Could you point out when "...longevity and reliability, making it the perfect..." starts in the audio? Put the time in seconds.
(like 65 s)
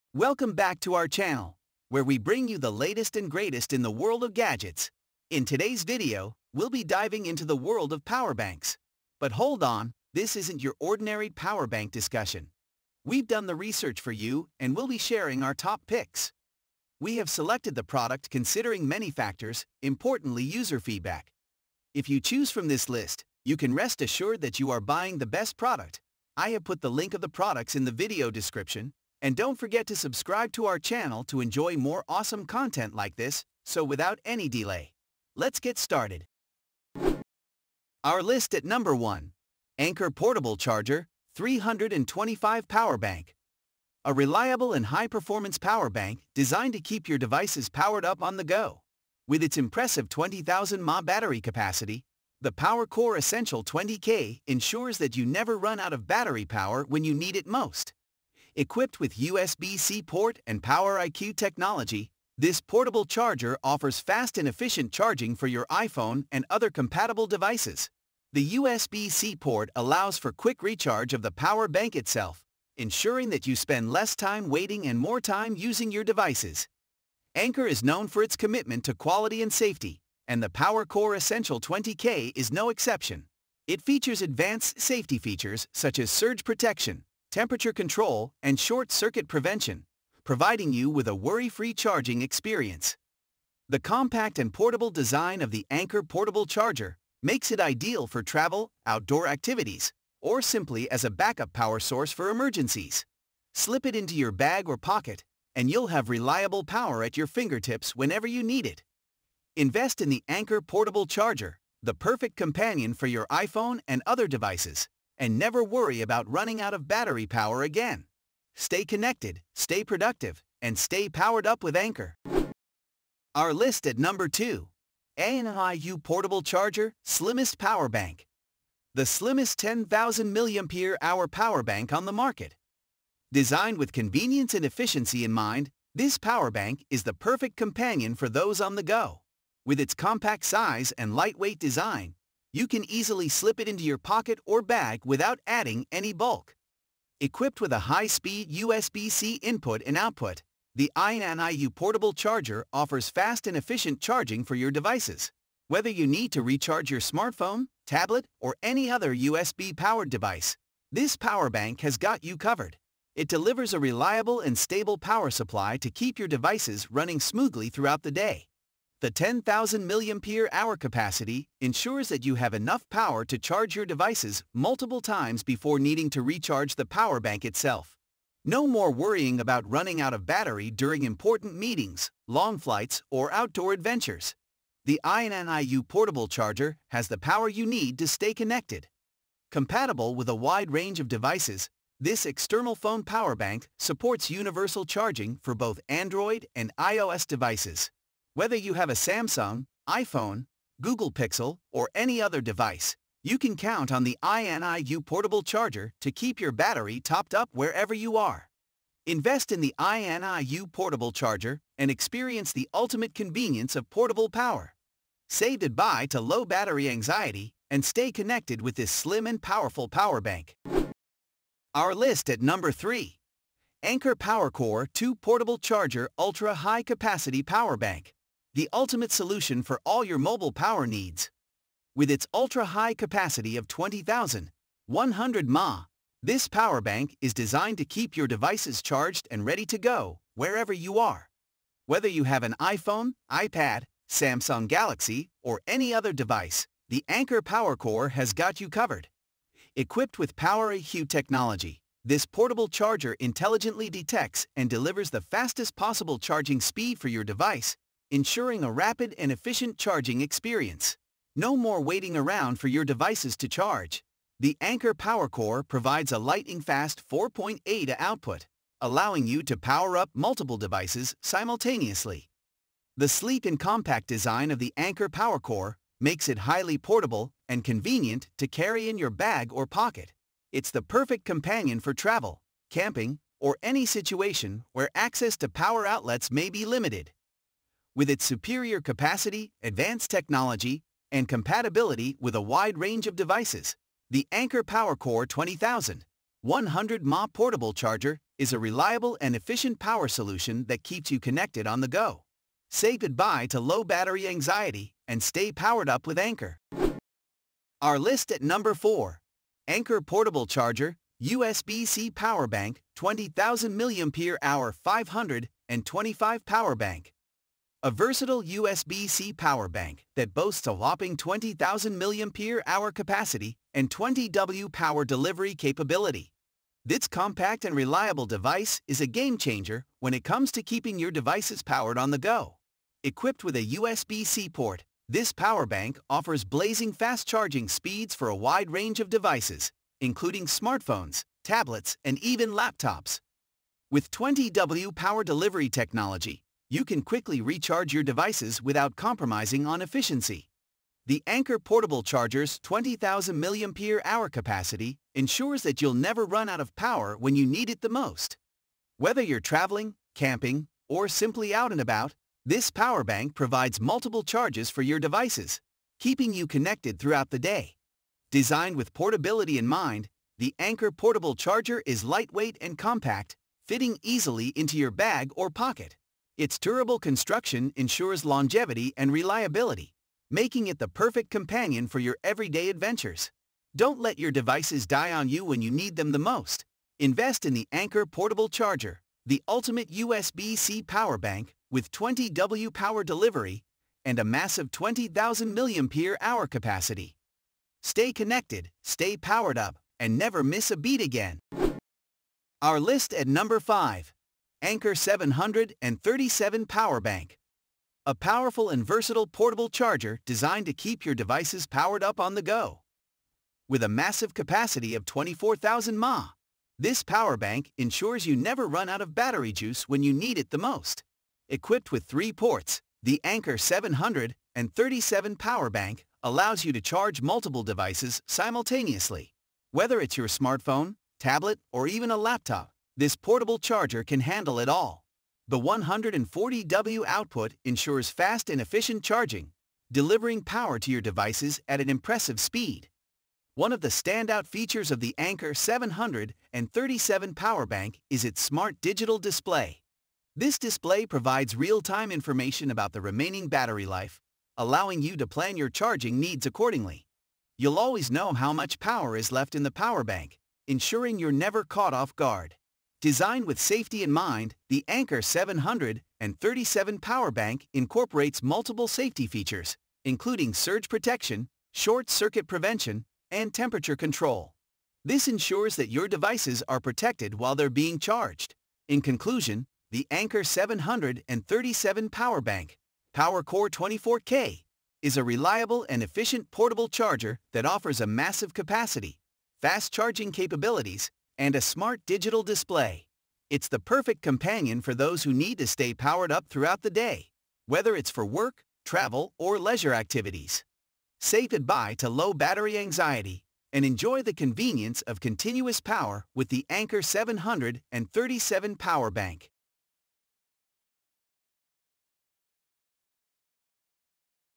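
378 s.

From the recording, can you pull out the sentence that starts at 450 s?
This display provides real-time information about the remaining battery life, allowing you to plan your charging needs accordingly.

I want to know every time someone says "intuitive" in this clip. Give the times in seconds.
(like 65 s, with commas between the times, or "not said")
not said.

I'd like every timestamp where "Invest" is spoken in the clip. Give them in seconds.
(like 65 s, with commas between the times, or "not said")
109 s, 209 s, 386 s.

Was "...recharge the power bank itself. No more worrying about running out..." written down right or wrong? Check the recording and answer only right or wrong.
right.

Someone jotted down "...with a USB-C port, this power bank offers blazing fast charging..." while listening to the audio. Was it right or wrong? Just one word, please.
right.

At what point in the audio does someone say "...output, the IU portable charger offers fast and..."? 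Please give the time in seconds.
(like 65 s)
149 s.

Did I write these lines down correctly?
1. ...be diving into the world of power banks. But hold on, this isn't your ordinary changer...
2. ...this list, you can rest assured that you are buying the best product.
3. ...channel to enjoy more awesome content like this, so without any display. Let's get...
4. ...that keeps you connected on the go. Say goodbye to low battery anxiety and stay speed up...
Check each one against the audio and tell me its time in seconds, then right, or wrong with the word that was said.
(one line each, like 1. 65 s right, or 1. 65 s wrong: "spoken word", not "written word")
1. 6 s wrong: "power", not "changer"
2. 22 s right
3. 30 s wrong: "delay", not "display"
4. 300 s wrong: "powered", not "speed".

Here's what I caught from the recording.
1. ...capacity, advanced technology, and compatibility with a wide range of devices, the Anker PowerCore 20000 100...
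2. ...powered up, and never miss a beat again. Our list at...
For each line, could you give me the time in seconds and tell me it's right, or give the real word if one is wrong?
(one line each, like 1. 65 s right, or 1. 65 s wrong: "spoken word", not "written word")
1. 288 s right
2. 399 s right.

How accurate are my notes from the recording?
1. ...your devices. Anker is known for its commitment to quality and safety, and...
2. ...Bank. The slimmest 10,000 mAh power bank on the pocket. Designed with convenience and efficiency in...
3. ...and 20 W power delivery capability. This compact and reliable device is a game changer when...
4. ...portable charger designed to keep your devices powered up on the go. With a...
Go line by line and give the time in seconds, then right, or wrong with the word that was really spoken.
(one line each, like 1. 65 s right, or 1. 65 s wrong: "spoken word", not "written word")
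1. 75 s right
2. 127 s wrong: "market", not "pocket"
3. 323 s right
4. 409 s right.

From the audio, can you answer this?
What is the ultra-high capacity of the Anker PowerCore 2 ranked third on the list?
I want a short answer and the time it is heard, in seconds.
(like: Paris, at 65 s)
20,100 mAh, at 233 s.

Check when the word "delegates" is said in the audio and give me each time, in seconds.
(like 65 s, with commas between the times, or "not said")
not said.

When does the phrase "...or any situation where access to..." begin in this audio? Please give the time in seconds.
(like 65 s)
283 s.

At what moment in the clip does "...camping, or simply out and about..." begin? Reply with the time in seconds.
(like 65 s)
360 s.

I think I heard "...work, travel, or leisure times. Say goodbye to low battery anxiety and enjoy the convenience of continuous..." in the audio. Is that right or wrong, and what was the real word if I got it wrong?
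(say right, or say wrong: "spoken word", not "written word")
wrong: "activities", not "times".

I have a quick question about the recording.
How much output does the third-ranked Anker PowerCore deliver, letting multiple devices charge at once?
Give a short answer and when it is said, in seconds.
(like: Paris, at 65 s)
4.8 A, at 267 s.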